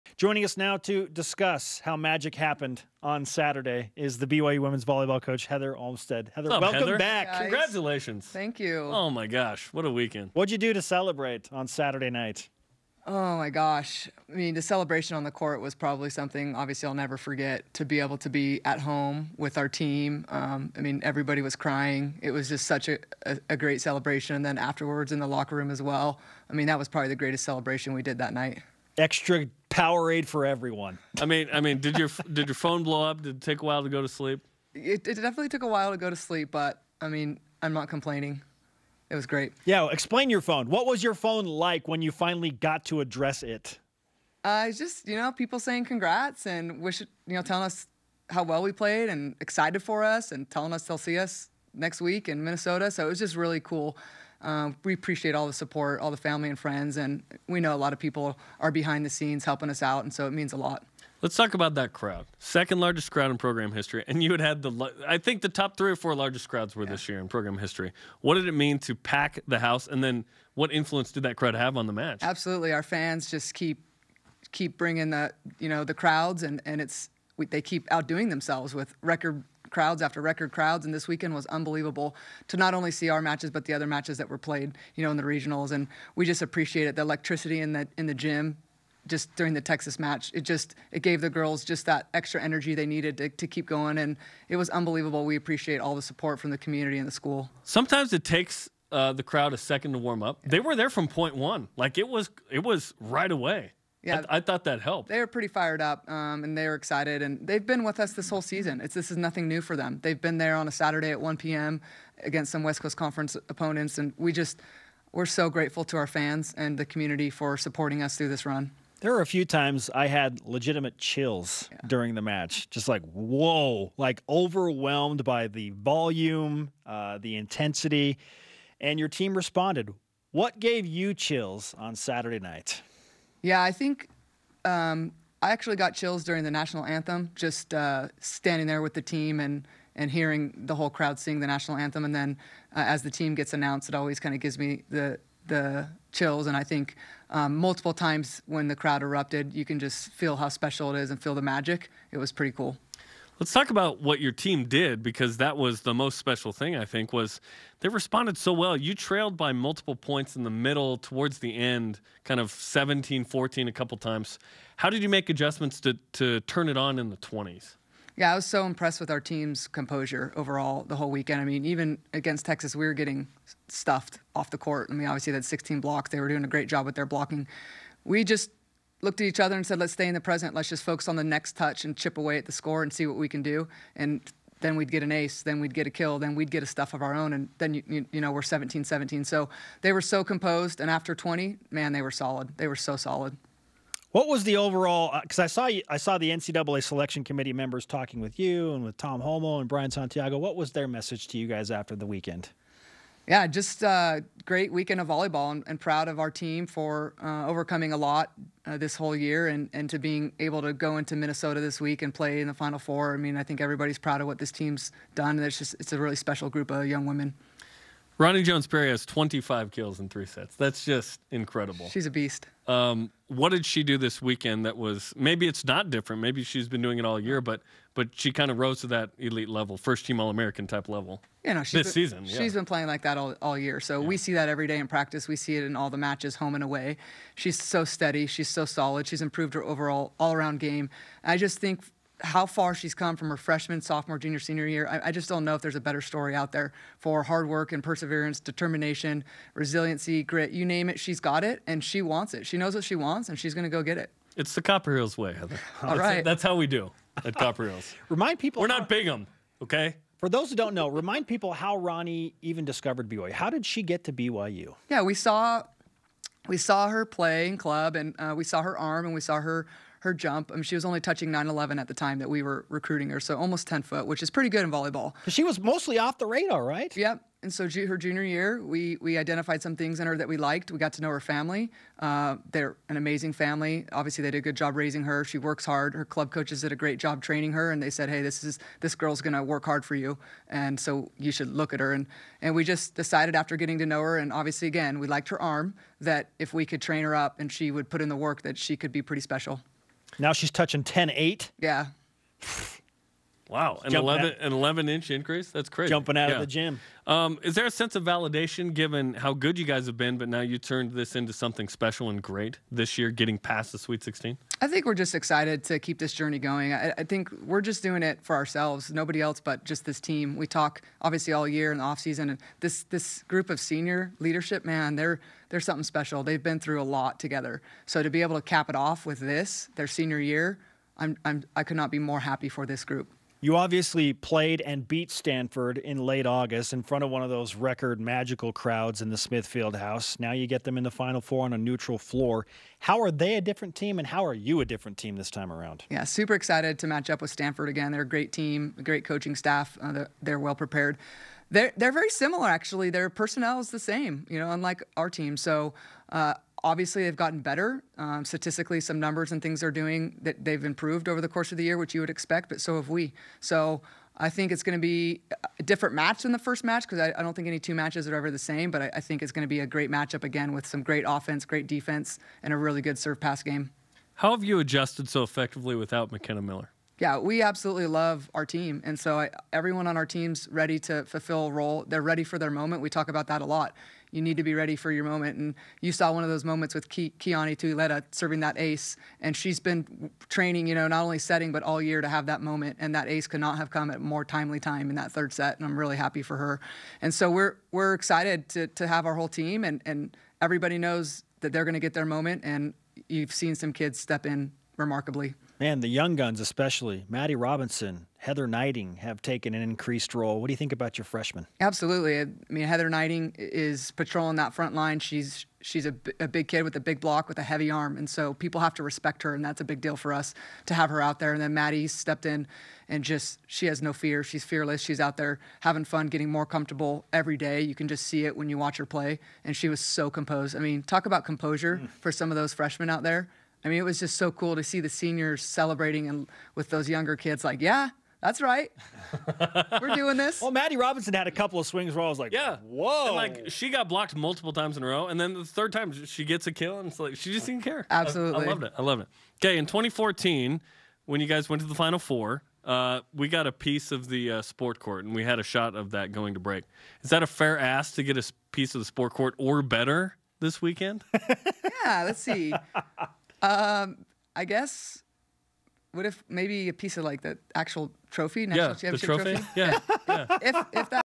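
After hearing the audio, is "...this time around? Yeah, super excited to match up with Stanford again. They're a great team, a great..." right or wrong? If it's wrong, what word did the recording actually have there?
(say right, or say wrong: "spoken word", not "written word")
right.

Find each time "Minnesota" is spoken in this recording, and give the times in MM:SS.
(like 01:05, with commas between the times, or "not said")
00:52, 03:31.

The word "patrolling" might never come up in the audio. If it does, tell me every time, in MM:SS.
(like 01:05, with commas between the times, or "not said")
06:53.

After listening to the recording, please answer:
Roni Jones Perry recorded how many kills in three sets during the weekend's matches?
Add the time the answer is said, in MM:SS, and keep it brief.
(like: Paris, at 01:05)
25, at 03:39.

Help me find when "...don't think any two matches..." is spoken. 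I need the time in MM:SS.
06:07.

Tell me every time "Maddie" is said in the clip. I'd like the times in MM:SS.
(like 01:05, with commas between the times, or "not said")
06:47, 07:01, 07:20.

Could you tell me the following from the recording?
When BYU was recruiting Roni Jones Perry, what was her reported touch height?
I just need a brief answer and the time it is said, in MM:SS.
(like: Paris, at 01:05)
9-11, at 04:31.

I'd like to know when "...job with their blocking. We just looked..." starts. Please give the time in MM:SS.
02:56.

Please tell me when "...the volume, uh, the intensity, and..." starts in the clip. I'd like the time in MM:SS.
02:05.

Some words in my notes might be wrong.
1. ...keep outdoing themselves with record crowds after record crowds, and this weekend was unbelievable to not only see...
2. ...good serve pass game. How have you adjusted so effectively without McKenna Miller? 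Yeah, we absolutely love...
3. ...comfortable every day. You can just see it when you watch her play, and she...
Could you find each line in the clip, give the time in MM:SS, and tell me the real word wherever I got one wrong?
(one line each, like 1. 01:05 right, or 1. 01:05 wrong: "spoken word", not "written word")
1. 01:17 right
2. 06:12 right
3. 07:06 right.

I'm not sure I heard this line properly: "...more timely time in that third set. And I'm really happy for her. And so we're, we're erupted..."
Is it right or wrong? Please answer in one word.
wrong.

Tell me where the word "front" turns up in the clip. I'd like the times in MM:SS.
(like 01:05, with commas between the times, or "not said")
05:36, 06:54.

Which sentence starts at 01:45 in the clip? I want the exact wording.
They are pretty fired up, um, and they are excited, and they've been with us this whole season.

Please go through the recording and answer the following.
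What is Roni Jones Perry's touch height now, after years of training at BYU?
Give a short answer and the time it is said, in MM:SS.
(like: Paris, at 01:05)
10 8, at 05:00.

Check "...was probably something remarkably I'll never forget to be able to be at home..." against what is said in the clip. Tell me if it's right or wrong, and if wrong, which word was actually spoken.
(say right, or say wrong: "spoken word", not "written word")
wrong: "obviously", not "remarkably".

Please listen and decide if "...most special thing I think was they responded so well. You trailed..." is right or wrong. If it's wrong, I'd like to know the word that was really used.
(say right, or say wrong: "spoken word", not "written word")
right.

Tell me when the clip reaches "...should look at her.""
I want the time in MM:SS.
04:51.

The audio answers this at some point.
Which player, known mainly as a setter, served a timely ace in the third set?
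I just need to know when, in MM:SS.
06:27.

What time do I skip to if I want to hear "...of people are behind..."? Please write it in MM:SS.
00:57.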